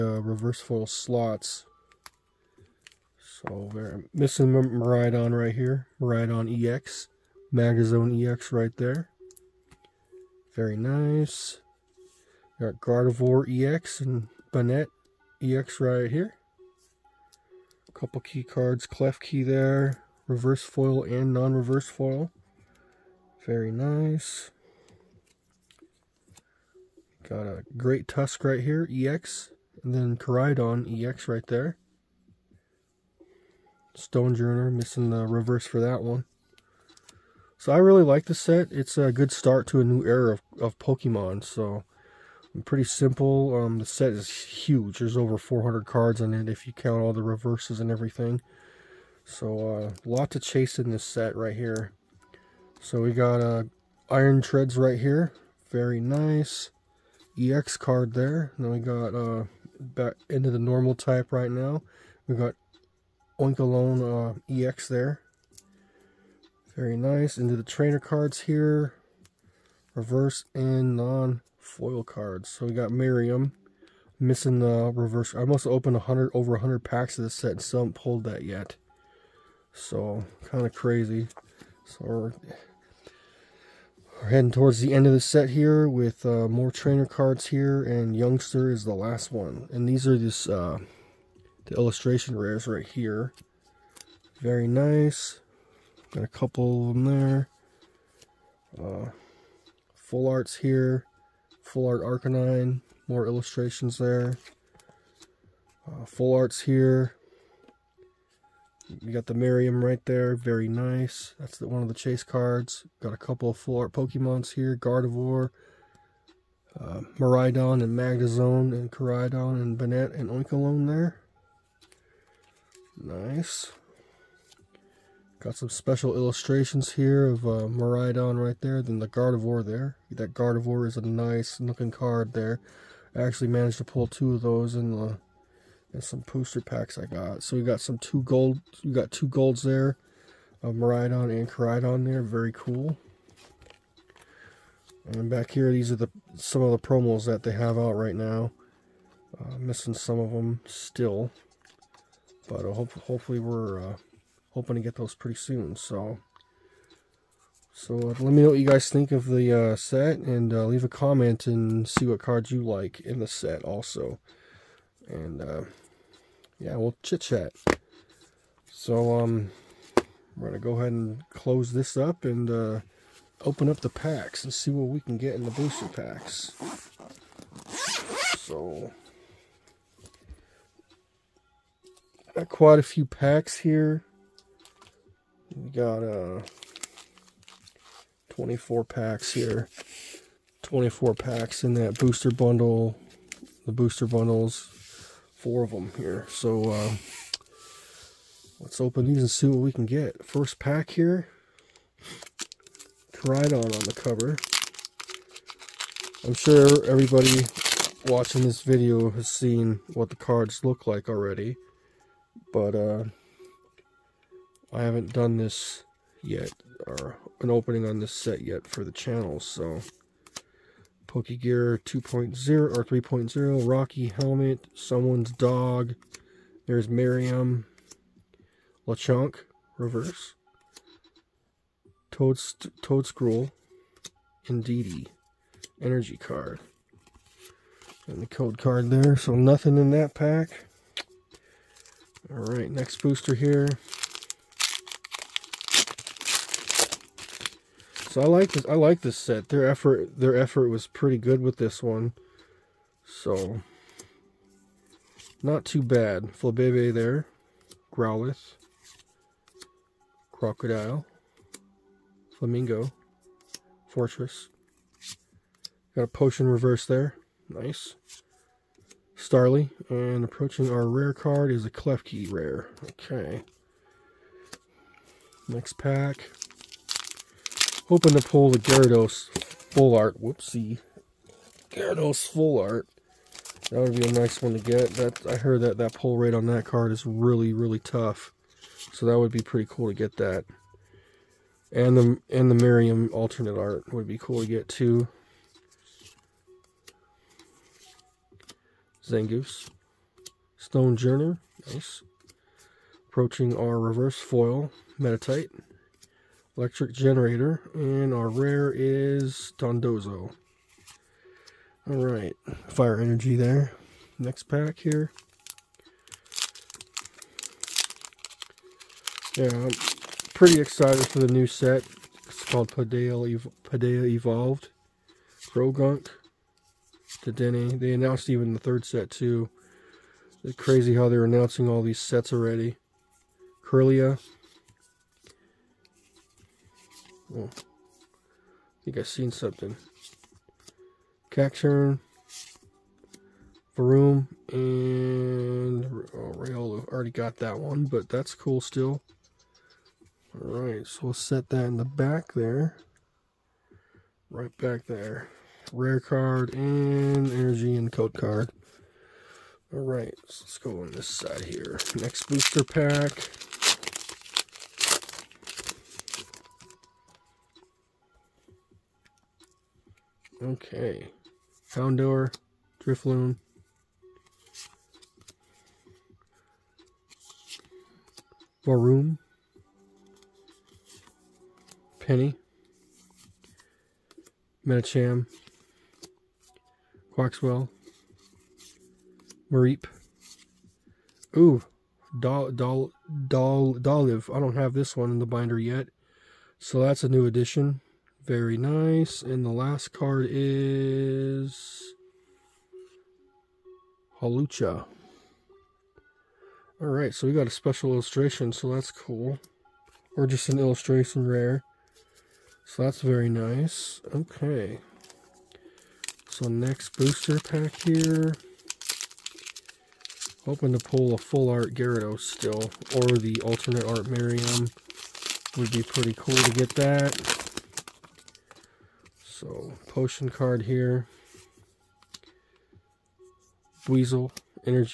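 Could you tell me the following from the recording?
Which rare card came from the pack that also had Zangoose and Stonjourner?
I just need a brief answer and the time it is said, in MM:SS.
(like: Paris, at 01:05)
Dondozo, at 05:09.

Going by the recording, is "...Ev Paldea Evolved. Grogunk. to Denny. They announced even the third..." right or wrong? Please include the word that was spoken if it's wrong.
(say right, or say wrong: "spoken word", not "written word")
right.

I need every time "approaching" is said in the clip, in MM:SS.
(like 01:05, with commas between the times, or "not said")
04:30, 05:03.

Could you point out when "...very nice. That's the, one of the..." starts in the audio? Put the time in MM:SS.
01:50.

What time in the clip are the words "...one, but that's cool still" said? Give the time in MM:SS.
05:47.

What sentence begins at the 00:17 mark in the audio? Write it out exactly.
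A couple key cards, Klefki there, reverse foil and non-reverse foil.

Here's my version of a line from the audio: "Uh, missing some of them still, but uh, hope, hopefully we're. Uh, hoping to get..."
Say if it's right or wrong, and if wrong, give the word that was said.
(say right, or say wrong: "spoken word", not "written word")
right.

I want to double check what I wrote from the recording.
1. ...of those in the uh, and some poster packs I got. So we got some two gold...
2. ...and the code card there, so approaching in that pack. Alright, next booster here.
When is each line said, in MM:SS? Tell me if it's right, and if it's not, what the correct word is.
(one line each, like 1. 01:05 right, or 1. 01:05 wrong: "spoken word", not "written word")
1. 02:14 right
2. 03:58 wrong: "nothing", not "approaching".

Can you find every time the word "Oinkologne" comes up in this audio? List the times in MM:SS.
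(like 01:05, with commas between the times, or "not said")
01:03, 02:00.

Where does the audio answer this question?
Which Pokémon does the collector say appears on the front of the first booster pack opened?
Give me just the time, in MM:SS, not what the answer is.
03:23.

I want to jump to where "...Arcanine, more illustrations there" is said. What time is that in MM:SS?
01:42.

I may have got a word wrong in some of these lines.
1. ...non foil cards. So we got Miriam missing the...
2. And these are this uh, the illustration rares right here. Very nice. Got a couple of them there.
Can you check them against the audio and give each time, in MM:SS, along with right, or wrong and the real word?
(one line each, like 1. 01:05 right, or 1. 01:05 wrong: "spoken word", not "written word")
1. 01:10 right
2. 01:29 right.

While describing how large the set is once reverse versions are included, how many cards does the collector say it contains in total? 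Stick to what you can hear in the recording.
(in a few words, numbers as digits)
over 400.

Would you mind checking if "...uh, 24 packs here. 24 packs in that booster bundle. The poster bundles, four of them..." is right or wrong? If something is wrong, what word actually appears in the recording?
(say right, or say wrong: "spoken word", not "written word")
wrong: "booster", not "poster".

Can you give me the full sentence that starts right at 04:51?
And the and the Miriam alternate art would be cool to get too.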